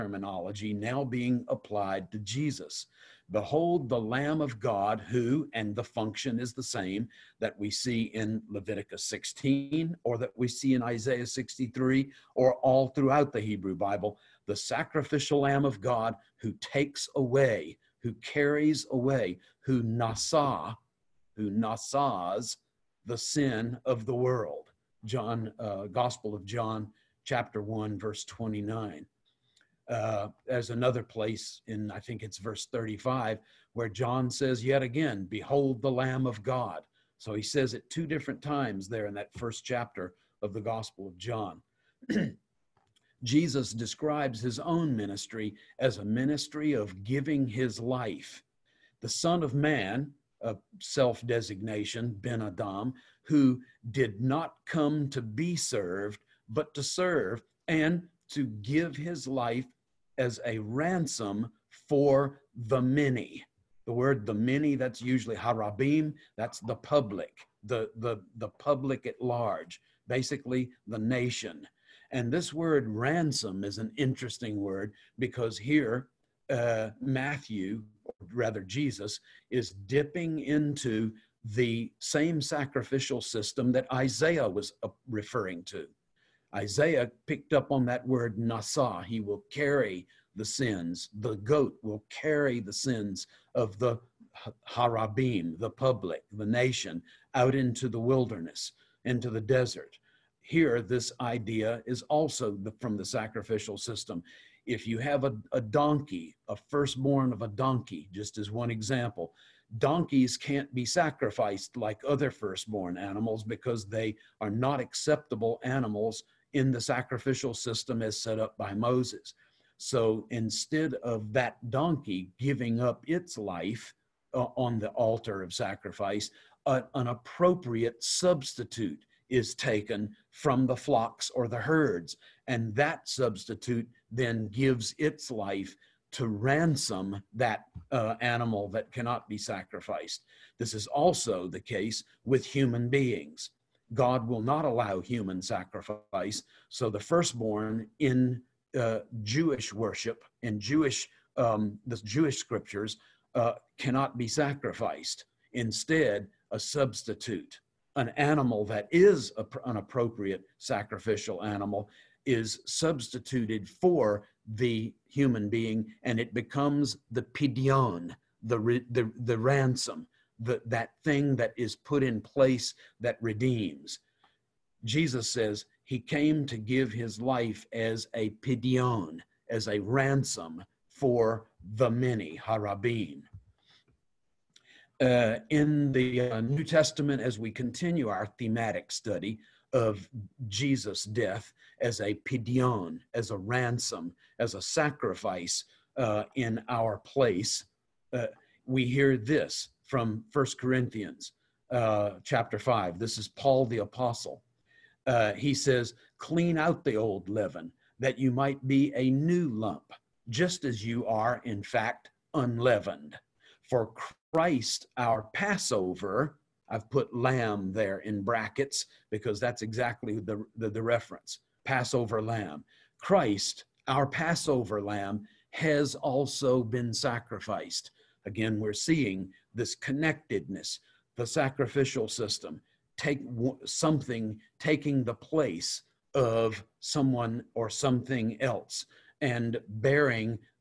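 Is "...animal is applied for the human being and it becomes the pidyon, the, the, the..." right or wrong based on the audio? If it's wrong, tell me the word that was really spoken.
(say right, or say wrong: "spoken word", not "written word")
wrong: "substituted", not "applied".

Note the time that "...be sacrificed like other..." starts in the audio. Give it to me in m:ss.
1:50.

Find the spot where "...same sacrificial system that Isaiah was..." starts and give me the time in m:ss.
1:22.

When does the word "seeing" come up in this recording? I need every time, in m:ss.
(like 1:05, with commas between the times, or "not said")
3:48.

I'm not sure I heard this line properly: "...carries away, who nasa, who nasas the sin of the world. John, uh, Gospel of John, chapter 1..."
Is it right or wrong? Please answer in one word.
right.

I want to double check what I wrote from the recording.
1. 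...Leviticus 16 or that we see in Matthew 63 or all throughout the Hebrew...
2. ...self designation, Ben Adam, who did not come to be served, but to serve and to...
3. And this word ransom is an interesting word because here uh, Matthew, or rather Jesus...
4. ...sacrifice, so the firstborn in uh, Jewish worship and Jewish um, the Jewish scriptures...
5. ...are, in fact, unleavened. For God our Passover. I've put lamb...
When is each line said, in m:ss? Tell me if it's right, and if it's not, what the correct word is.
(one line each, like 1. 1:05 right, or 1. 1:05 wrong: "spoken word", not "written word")
1. 0:08 wrong: "Isaiah", not "Matthew"
2. 0:50 right
3. 1:12 right
4. 2:25 right
5. 3:31 wrong: "Christ", not "God".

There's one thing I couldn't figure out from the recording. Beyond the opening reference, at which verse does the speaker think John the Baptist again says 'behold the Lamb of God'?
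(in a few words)
35.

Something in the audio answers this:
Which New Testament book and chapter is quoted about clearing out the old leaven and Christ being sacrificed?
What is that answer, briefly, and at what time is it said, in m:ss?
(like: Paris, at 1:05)
First Corinthians 5, at 3:20.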